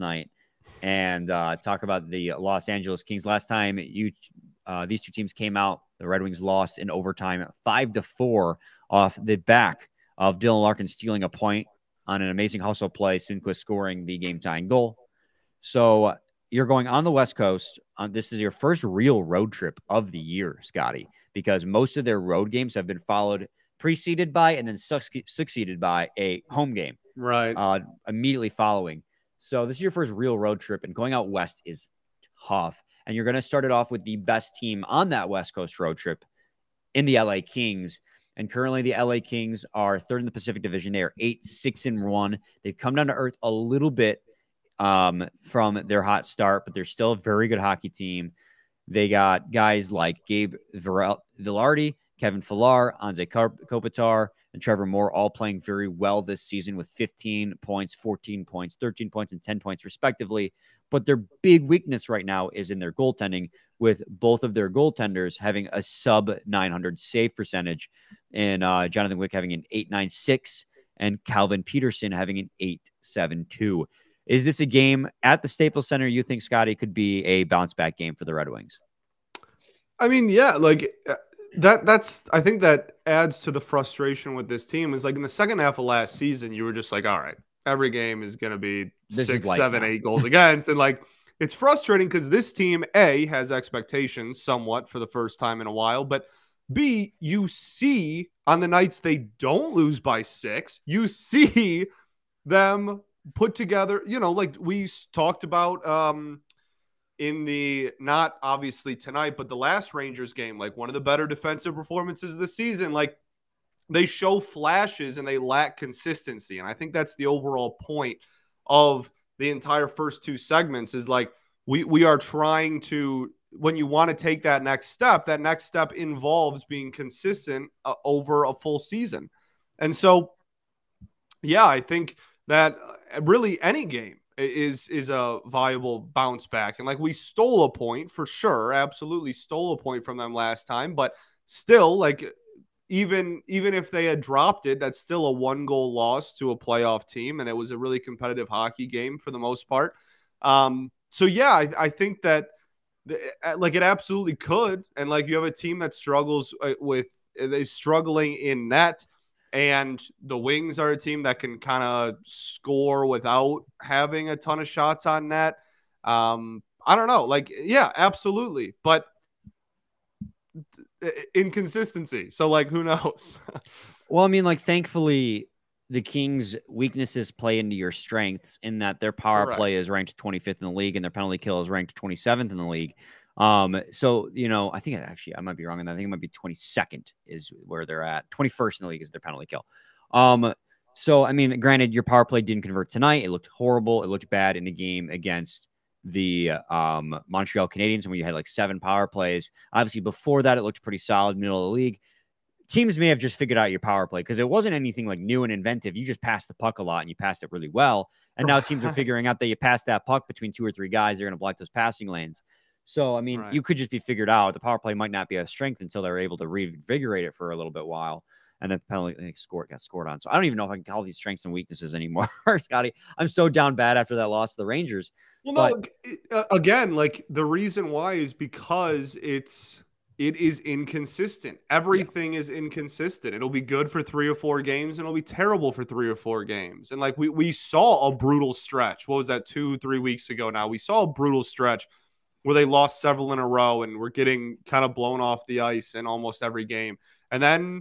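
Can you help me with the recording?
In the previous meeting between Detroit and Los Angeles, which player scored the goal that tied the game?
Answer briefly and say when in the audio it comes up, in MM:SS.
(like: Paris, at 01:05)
Sundqvist, at 00:13.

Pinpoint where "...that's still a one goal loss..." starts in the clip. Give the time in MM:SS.
02:24.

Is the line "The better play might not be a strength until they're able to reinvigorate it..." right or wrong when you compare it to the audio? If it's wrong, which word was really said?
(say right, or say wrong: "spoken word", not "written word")
wrong: "power", not "better".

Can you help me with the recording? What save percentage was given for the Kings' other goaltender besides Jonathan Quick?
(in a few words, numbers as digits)
872.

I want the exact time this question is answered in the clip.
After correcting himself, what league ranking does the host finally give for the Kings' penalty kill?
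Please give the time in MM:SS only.
03:08.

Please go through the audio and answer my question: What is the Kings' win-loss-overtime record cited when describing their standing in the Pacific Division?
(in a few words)
8-6-1.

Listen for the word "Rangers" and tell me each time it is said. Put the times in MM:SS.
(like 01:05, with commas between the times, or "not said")
01:49, 03:44.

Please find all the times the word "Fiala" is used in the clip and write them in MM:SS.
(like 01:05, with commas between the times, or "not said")
00:52.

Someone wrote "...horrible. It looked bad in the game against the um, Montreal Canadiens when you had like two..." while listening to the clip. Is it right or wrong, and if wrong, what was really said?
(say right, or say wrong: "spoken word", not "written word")
wrong: "seven", not "two".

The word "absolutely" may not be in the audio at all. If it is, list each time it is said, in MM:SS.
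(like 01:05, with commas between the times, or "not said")
02:18, 02:33, 02:47.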